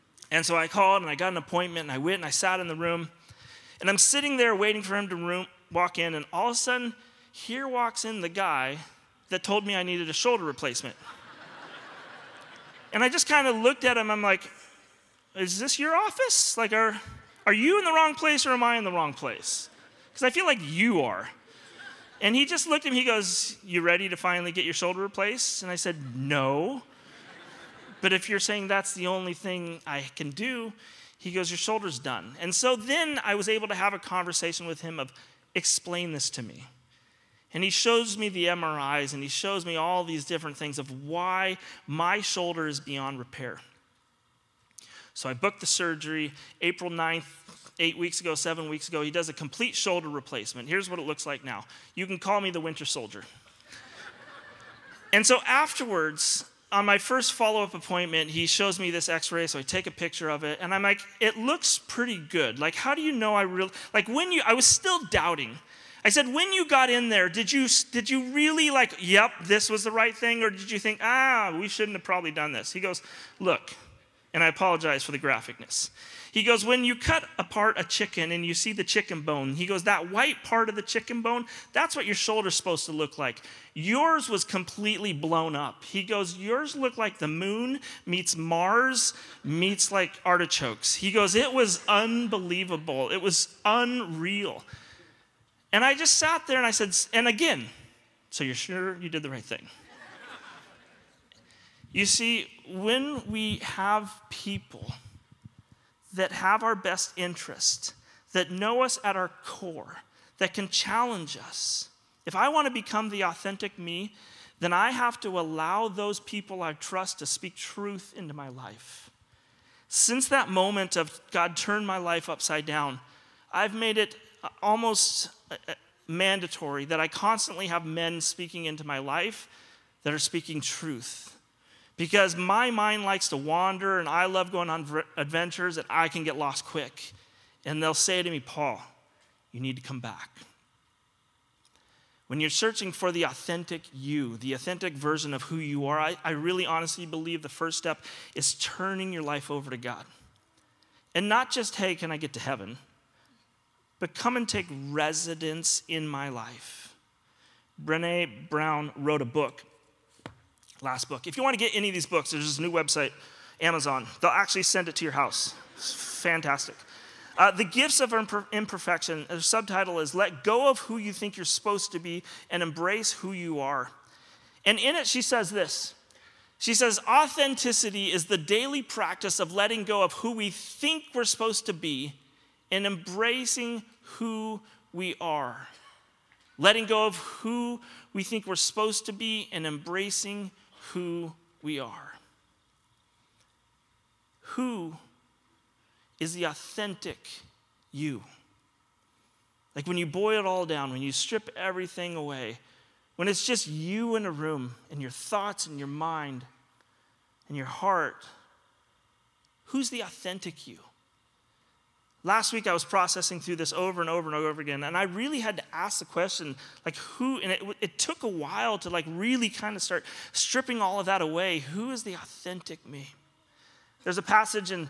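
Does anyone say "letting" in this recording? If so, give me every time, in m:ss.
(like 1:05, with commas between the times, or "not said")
2:59, 3:06.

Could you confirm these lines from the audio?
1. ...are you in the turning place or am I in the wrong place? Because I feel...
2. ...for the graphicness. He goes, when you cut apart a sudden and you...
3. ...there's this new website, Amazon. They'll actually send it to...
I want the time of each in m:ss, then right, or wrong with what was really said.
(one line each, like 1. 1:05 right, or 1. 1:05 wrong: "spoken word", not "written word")
1. 0:17 wrong: "wrong", not "turning"
2. 1:15 wrong: "chicken", not "sudden"
3. 2:42 right.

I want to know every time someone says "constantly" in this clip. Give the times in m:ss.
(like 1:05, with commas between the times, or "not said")
2:07.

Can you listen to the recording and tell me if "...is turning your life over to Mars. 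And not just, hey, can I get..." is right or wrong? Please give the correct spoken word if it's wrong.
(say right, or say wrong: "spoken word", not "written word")
wrong: "God", not "Mars".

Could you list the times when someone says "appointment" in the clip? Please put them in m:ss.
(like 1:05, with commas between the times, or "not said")
0:01, 0:57.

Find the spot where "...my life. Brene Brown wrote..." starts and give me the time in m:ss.
2:36.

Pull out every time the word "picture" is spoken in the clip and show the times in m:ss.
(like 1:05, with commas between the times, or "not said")
0:59.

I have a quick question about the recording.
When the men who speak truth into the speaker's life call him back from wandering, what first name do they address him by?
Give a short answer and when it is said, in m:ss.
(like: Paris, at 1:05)
Paul, at 2:18.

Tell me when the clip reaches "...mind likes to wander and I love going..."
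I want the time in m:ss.
2:12.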